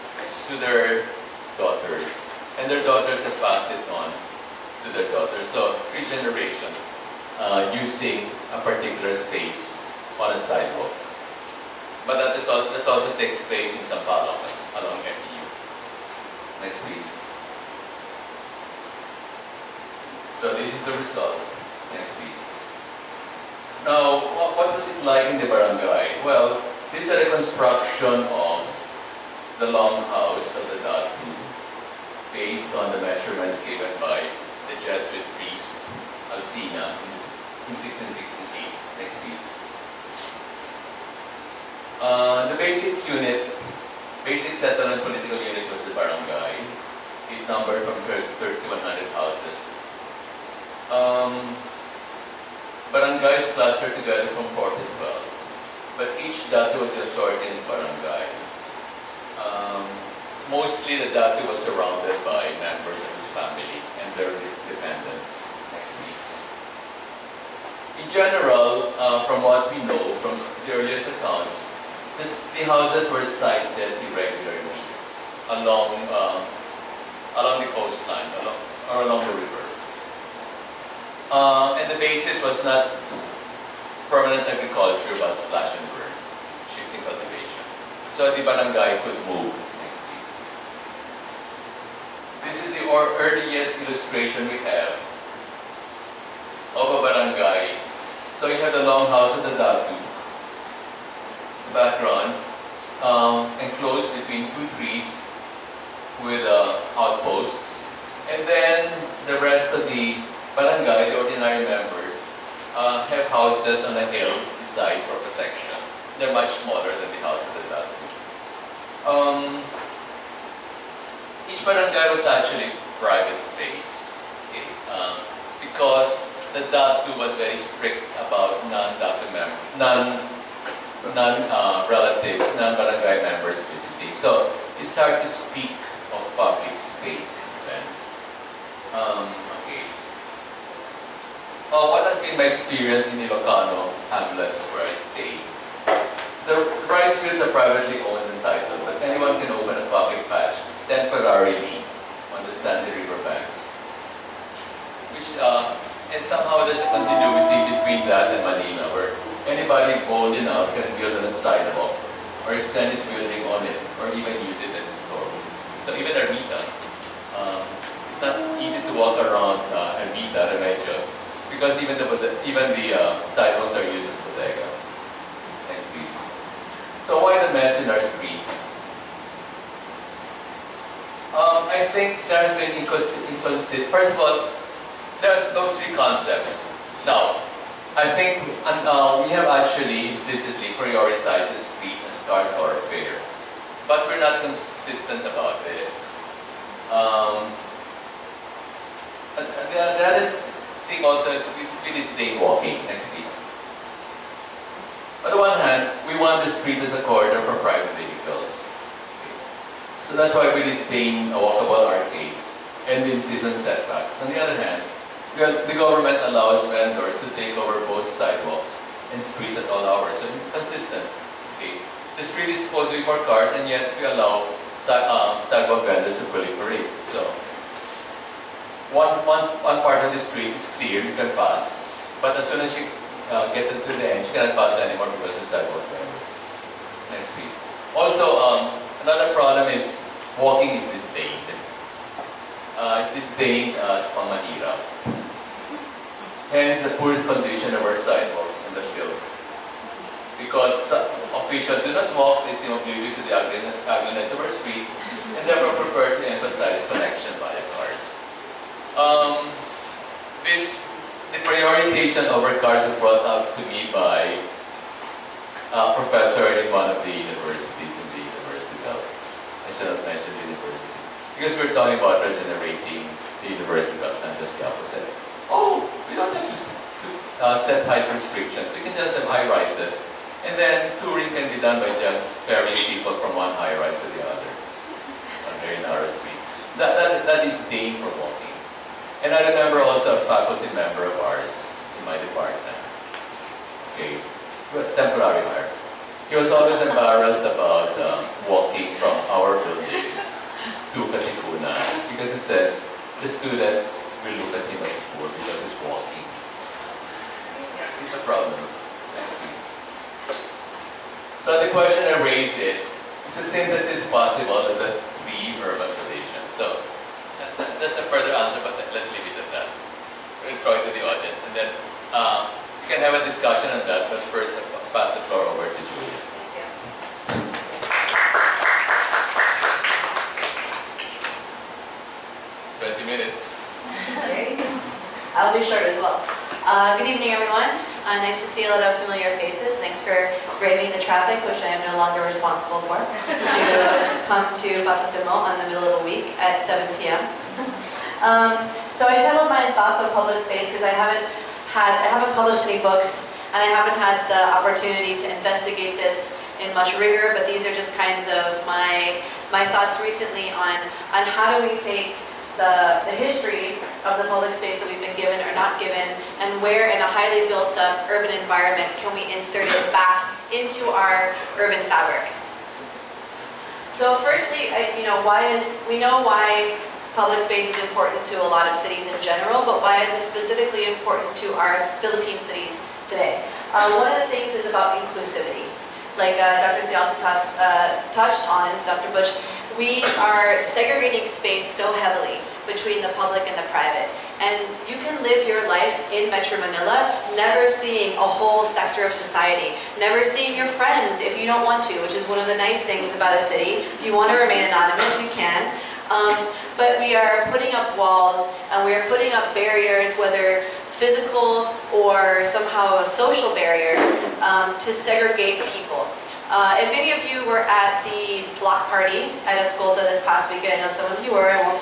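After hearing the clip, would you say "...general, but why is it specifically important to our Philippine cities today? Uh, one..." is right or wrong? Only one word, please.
right.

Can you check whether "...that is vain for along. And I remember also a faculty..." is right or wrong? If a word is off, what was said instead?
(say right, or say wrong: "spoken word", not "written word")
wrong: "walking", not "along".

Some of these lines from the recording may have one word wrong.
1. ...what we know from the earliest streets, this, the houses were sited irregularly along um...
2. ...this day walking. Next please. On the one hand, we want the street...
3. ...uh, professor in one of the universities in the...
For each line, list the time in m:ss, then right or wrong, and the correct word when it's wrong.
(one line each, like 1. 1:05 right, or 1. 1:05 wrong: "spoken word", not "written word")
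1. 1:09 wrong: "accounts", not "streets"
2. 3:21 right
3. 4:25 right.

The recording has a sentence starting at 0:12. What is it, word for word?
But that, is, that also takes place So this is the result.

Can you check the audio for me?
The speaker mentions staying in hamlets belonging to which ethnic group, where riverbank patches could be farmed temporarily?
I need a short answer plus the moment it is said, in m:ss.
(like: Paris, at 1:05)
Ilocano, at 2:23.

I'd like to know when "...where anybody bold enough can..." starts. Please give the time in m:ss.
2:38.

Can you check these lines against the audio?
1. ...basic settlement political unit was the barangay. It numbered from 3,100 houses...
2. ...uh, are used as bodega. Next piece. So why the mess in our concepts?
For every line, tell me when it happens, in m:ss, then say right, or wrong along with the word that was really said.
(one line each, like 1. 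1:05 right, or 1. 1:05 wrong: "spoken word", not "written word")
1. 0:44 right
2. 2:52 wrong: "streets", not "concepts".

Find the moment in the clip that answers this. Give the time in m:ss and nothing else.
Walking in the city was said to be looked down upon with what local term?
4:04.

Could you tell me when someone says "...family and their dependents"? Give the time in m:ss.
1:03.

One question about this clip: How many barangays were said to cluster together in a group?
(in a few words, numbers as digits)
4 to 12.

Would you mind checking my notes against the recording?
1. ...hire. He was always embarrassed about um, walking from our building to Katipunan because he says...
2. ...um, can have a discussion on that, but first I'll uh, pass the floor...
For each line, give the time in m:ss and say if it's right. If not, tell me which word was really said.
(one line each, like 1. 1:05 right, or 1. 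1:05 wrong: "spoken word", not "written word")
1. 4:55 right
2. 5:22 right.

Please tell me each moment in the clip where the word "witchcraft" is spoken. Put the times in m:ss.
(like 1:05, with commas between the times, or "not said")
not said.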